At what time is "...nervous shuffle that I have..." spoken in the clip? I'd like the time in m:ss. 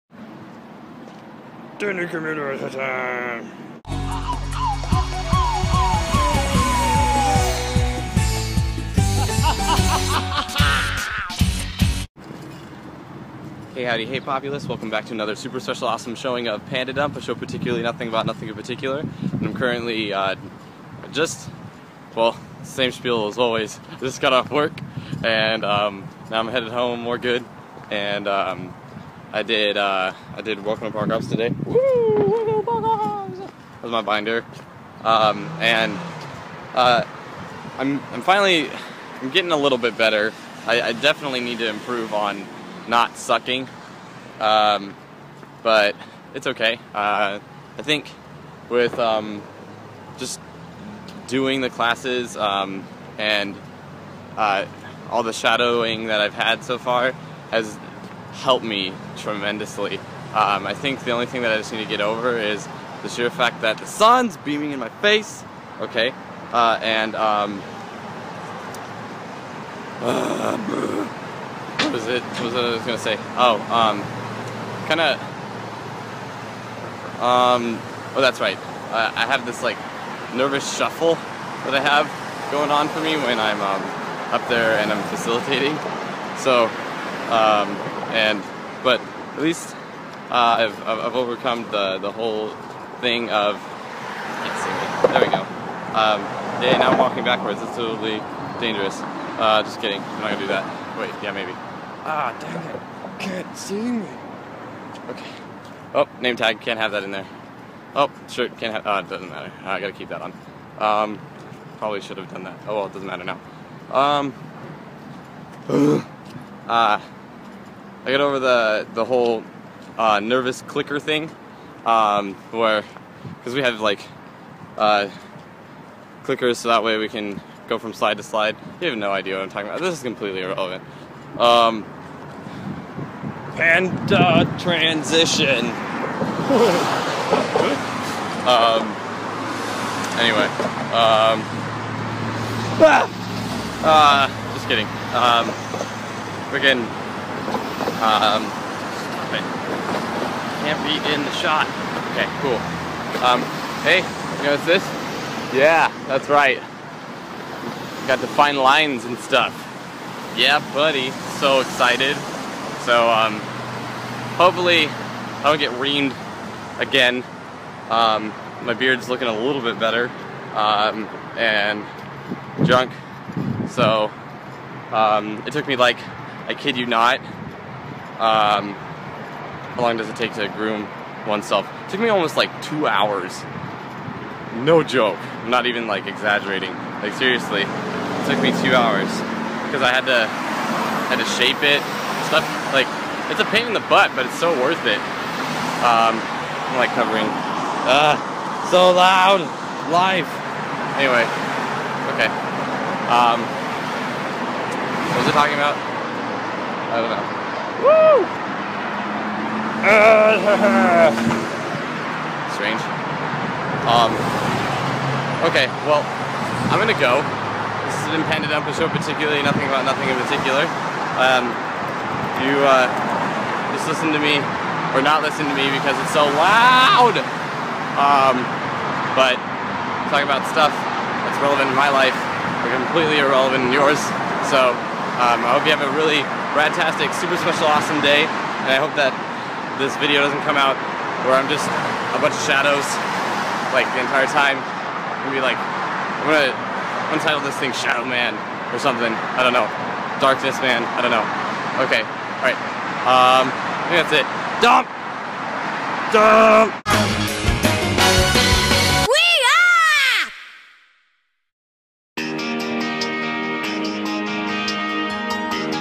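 1:20.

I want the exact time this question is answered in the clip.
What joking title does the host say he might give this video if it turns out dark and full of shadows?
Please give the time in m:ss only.
4:07.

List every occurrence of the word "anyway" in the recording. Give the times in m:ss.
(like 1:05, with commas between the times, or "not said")
2:20, 3:20.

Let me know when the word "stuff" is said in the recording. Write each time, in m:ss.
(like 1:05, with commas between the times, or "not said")
2:39, 3:12, 3:50.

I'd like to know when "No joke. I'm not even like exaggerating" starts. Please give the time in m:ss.
3:04.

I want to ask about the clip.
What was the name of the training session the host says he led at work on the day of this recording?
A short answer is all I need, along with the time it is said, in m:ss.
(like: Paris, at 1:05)
Welcome to Park Ops, at 0:30.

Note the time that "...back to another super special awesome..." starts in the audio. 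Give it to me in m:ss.
0:14.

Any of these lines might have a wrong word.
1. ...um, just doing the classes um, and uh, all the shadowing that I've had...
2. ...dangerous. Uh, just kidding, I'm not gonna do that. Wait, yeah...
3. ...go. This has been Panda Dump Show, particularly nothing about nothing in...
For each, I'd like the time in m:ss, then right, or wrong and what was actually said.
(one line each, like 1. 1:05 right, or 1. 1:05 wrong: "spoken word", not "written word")
1. 0:48 right
2. 1:38 right
3. 3:36 right.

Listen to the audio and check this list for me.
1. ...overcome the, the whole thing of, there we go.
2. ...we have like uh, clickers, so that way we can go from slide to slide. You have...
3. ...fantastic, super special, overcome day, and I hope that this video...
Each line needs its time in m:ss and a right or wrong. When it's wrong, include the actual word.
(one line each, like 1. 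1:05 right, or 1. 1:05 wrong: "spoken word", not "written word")
1. 1:31 right
2. 2:03 right
3. 3:56 wrong: "awesome", not "overcome".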